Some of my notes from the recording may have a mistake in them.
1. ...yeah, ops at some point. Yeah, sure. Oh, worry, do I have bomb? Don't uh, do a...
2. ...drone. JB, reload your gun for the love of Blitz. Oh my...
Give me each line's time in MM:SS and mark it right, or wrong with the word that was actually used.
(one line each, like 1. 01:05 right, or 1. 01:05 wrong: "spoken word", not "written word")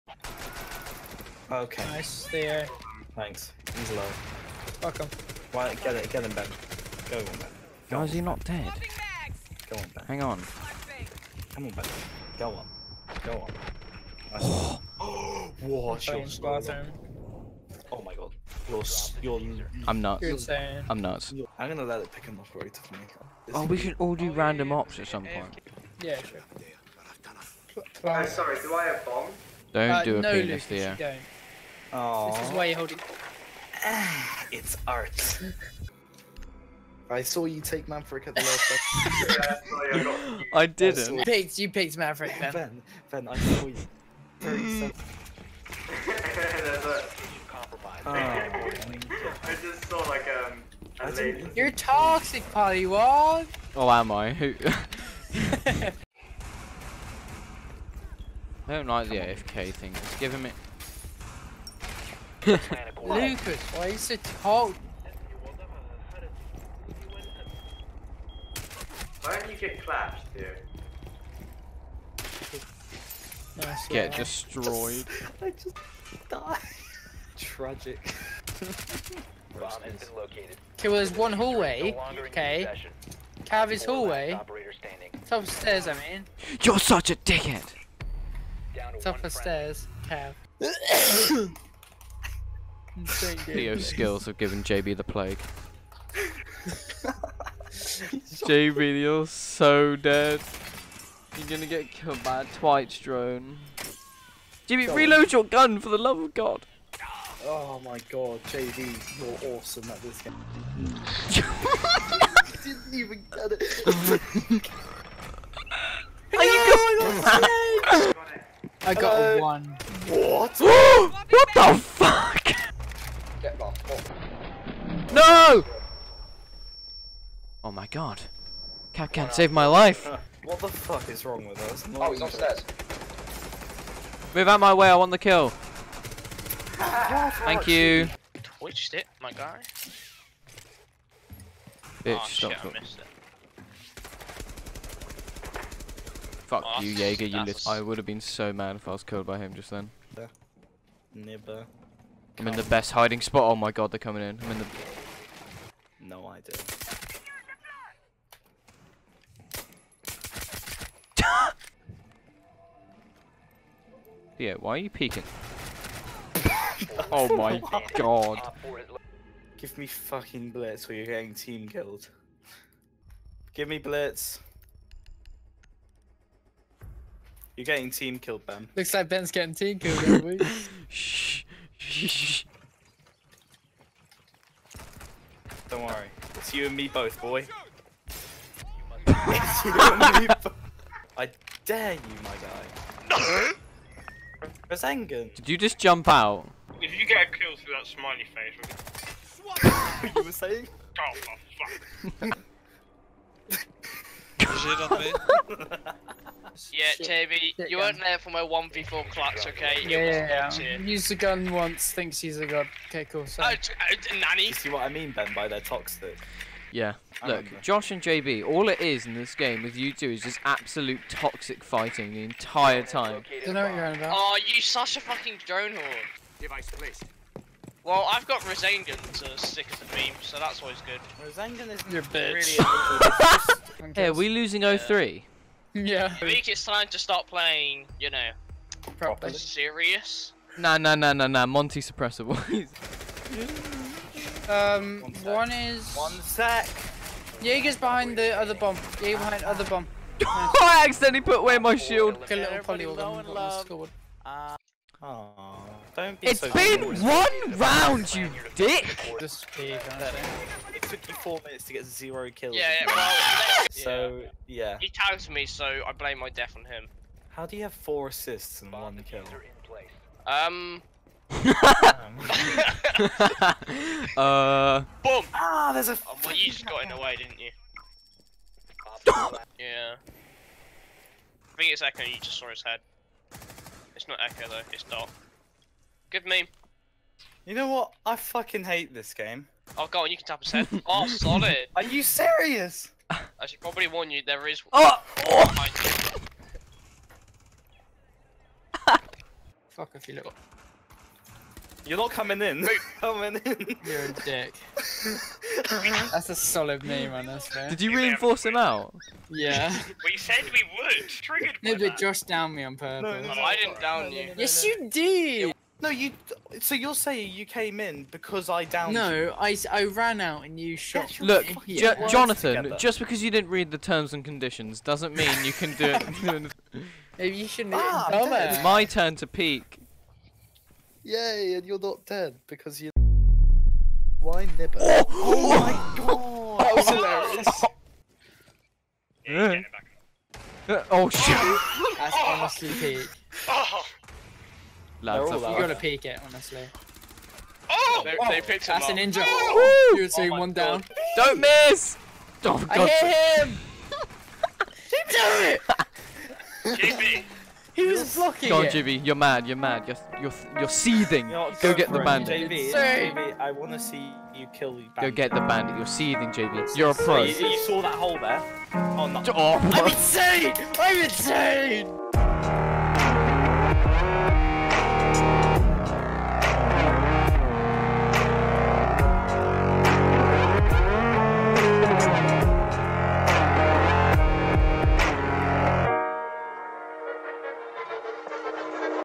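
1. 00:24 wrong: "sorry", not "worry"
2. 01:43 wrong: "God", not "Blitz".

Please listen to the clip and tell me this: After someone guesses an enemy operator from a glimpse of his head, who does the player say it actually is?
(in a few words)
Dot.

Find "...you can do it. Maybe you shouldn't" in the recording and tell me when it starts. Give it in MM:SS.
05:25.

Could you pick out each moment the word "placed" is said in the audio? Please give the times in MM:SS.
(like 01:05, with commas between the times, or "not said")
03:46.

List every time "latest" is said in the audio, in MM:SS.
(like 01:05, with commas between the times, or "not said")
not said.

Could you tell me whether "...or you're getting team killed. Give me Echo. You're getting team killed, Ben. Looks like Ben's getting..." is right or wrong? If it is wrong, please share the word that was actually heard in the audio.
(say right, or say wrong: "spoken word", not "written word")
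wrong: "Blitz", not "Echo".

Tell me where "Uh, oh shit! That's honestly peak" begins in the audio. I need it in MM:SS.
05:40.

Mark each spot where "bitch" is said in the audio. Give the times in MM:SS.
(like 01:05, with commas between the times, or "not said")
02:22, 03:52.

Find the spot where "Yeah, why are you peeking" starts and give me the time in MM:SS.
02:44.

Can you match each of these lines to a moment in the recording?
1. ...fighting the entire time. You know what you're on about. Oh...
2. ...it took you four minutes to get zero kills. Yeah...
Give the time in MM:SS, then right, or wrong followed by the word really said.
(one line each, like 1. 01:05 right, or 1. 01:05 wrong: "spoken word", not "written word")
1. 03:41 right
2. 04:19 right.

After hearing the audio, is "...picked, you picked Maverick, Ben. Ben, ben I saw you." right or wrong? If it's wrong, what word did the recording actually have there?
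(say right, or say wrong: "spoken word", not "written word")
right.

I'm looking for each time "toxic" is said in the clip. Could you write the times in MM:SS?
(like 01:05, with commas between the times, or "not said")
00:51, 03:35, 03:41.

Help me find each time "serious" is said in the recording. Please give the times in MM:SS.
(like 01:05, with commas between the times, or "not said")
03:59, 04:52.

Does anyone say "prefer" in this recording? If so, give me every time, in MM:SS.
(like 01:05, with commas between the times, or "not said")
not said.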